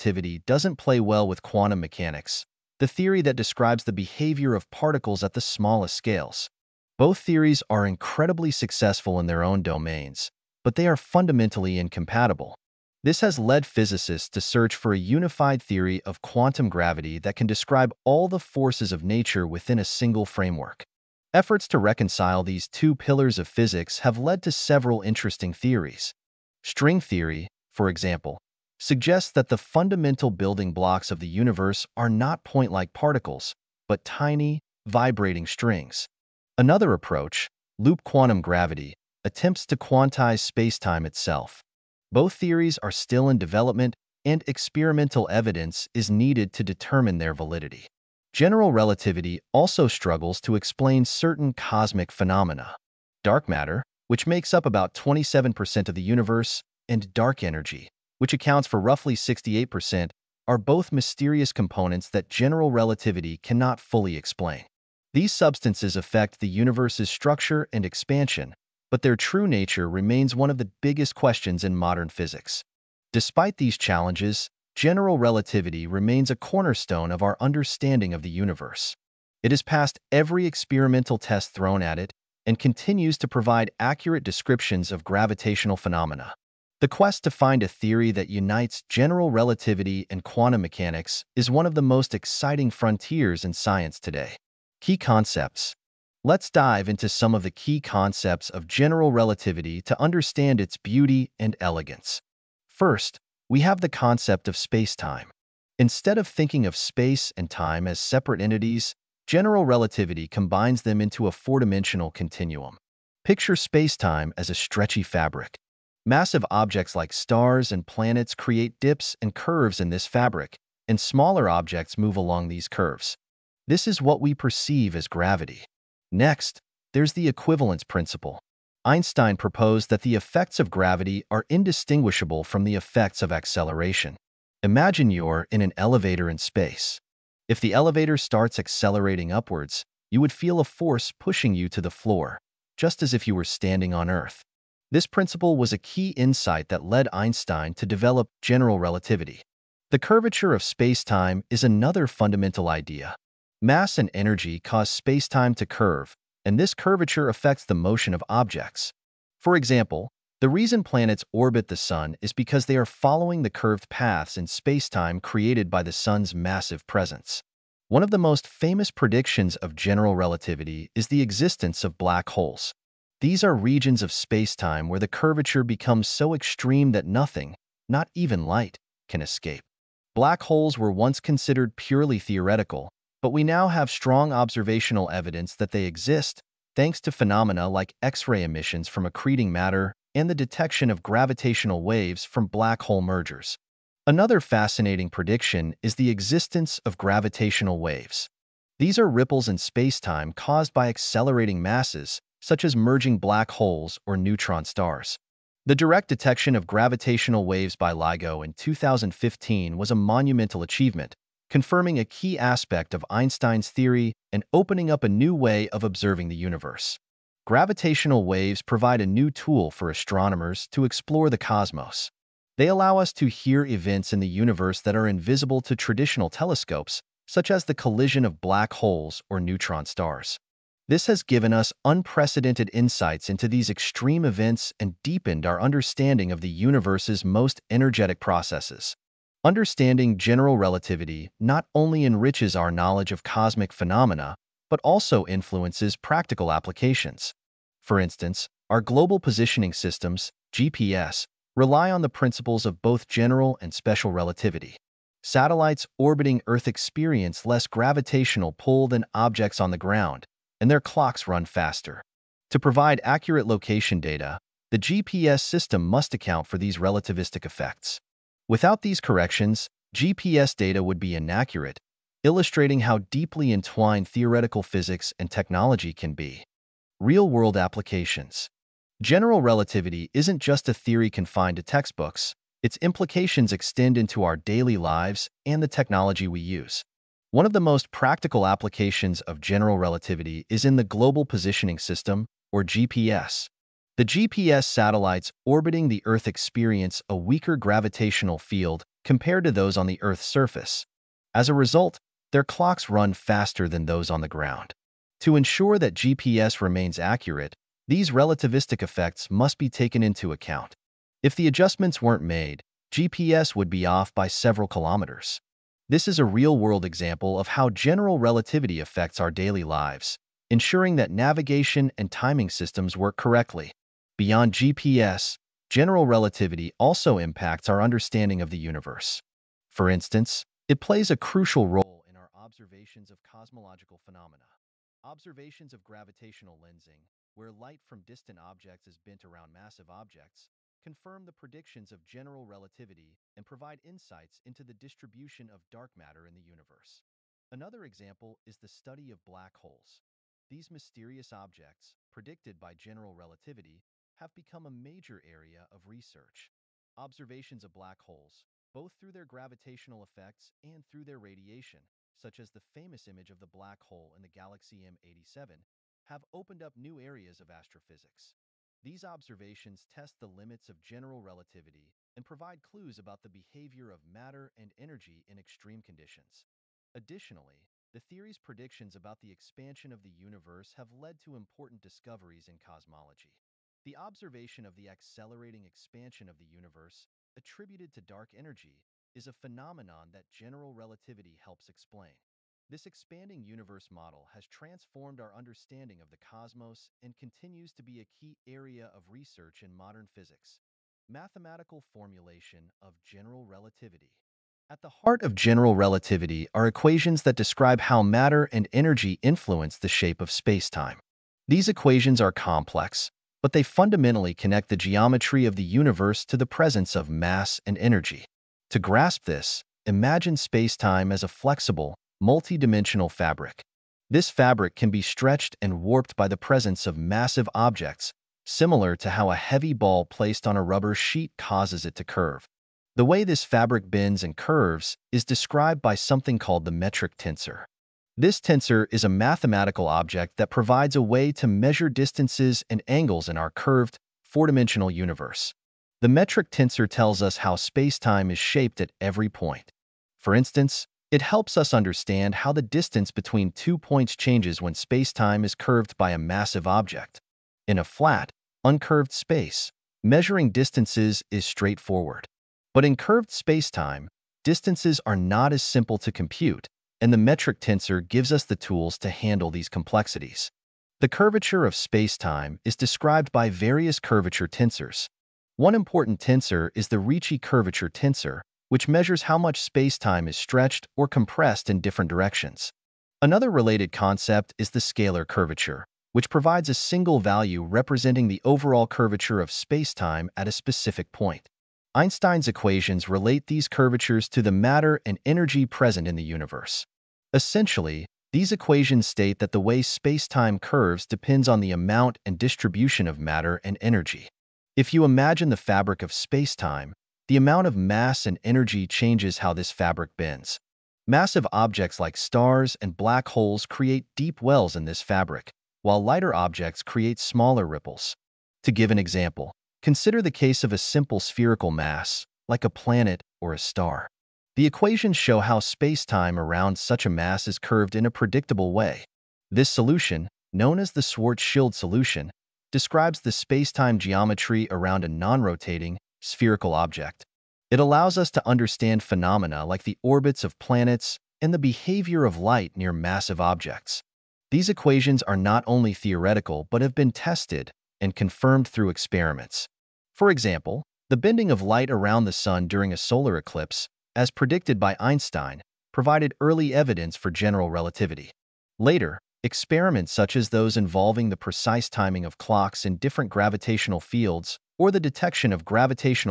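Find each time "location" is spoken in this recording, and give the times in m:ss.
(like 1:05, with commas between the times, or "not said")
4:23.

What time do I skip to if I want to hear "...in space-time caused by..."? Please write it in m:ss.
3:19.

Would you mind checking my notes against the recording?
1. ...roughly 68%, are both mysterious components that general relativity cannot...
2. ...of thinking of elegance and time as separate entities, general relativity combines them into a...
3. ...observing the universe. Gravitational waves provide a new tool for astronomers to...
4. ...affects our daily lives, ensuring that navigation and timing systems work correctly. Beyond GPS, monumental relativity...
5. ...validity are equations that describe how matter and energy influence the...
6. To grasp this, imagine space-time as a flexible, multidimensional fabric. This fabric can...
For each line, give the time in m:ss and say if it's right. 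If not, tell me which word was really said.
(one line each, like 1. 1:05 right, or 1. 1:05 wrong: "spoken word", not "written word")
1. 0:58 right
2. 1:46 wrong: "space", not "elegance"
3. 3:35 right
4. 5:18 wrong: "general", not "monumental"
5. 6:45 wrong: "relativity", not "validity"
6. 6:58 right.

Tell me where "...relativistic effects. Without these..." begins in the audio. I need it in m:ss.
4:26.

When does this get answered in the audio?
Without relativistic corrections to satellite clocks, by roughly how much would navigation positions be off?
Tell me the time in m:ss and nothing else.
5:14.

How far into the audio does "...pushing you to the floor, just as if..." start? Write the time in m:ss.
2:21.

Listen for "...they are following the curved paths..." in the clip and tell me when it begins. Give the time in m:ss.
2:42.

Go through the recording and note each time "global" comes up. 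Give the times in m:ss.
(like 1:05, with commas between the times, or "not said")
4:08, 4:50.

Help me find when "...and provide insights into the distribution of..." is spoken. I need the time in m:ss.
5:43.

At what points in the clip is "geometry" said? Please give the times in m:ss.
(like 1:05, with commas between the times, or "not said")
6:54, 8:53.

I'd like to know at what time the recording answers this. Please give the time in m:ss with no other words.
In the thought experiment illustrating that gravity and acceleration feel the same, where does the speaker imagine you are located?
2:15.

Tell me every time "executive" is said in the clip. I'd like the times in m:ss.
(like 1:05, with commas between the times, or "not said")
not said.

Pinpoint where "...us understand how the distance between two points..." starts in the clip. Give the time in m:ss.
7:31.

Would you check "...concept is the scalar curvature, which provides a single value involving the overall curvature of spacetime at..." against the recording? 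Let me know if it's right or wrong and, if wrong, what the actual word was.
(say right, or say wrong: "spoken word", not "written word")
wrong: "representing", not "involving".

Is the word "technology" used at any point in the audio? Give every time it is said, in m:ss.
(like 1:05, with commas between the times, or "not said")
4:35, 4:45.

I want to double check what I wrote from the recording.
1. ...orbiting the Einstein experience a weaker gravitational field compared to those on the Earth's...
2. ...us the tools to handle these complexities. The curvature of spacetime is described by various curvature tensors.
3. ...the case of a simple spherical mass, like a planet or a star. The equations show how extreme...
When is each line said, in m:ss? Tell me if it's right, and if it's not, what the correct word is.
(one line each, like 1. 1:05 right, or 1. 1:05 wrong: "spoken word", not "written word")
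1. 4:55 wrong: "Earth", not "Einstein"
2. 7:48 right
3. 8:40 wrong: "spacetime", not "extreme".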